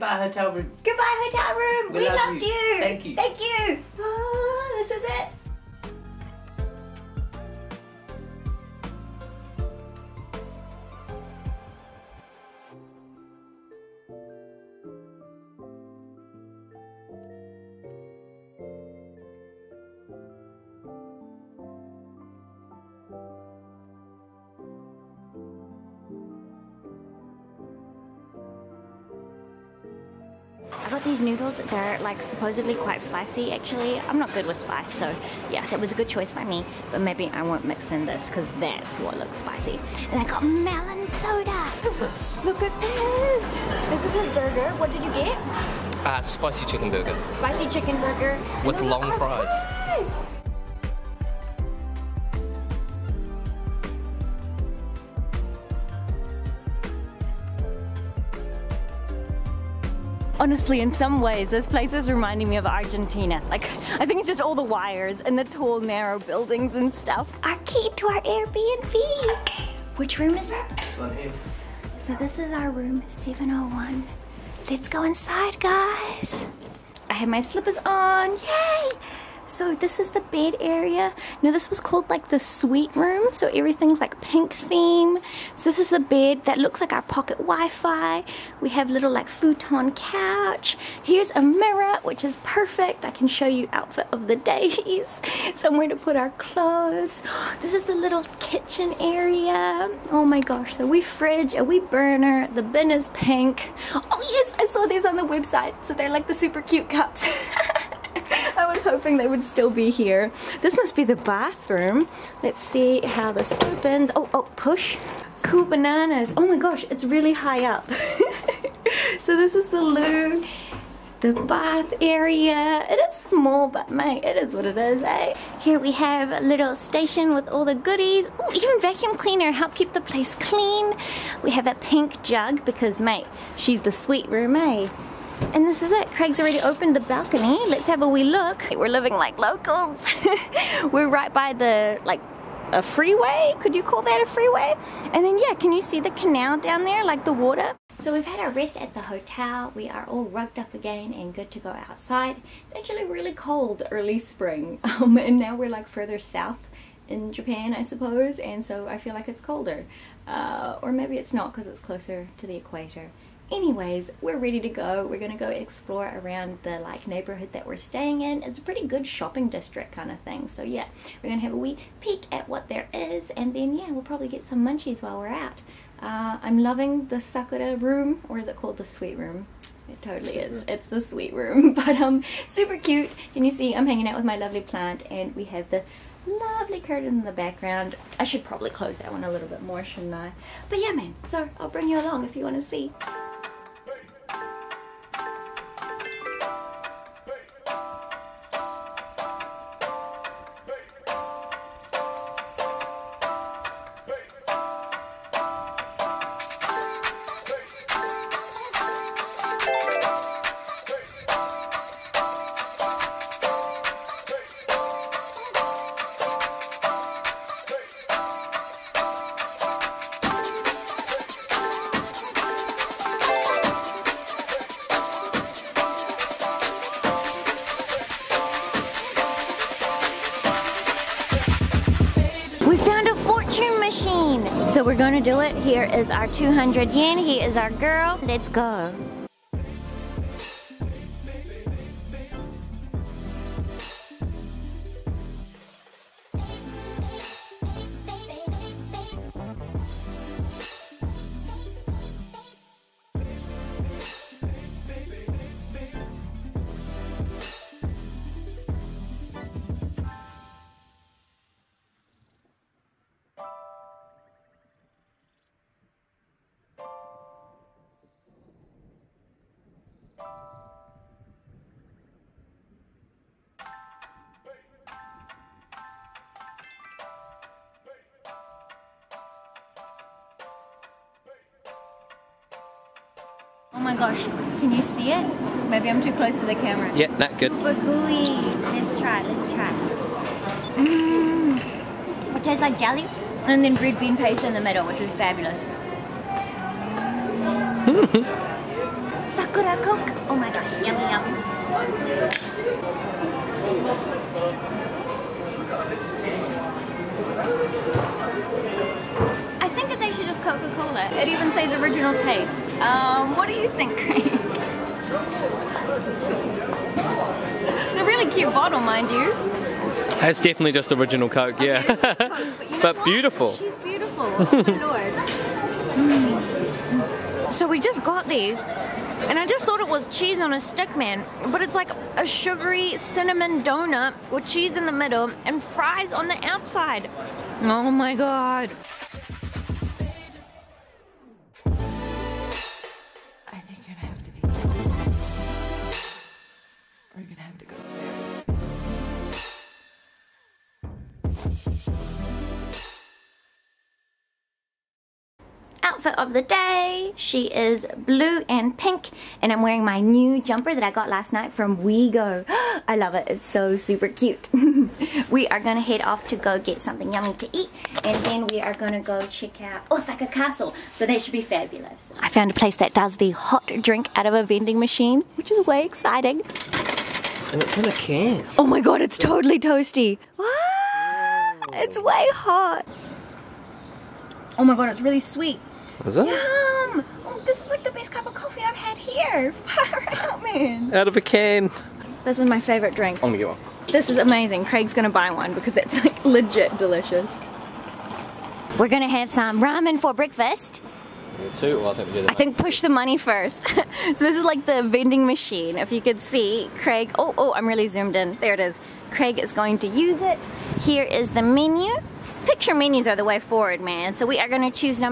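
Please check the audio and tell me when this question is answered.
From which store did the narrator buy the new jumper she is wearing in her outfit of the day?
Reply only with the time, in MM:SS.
06:01.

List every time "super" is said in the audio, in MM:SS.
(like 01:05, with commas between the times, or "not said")
01:46, 03:02, 04:47, 06:03.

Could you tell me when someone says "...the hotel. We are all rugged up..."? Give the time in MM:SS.
02:28.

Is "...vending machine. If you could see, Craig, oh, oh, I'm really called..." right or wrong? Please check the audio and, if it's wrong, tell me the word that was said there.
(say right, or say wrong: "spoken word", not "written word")
wrong: "zoomed", not "called".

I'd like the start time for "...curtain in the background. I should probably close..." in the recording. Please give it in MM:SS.
03:06.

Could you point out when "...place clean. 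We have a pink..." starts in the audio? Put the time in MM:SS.
02:10.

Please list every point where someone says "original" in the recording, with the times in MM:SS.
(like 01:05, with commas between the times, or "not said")
05:11, 05:20.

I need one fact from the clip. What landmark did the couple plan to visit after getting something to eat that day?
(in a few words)
Osaka Castle.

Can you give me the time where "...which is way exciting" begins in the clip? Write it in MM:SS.
06:15.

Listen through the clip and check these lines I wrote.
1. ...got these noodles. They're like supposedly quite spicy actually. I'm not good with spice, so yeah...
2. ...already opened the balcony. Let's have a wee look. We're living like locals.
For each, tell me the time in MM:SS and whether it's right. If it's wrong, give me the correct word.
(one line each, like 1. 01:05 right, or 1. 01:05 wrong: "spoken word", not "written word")
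1. 00:30 right
2. 02:16 right.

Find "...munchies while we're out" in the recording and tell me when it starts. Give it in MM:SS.
02:54.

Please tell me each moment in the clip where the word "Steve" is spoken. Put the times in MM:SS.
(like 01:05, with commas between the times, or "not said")
not said.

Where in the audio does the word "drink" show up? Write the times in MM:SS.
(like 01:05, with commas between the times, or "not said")
06:13, 06:32.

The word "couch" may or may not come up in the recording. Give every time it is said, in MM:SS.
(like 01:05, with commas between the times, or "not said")
01:29.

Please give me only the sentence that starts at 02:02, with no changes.
It is small, but mate, it is what it is, eh?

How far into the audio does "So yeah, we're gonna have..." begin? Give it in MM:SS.
02:50.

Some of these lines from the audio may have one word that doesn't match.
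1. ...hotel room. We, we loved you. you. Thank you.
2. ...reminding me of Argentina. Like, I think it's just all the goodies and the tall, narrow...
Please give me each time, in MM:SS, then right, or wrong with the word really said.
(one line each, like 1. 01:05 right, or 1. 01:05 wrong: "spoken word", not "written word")
1. 00:01 right
2. 01:02 wrong: "wires", not "goodies".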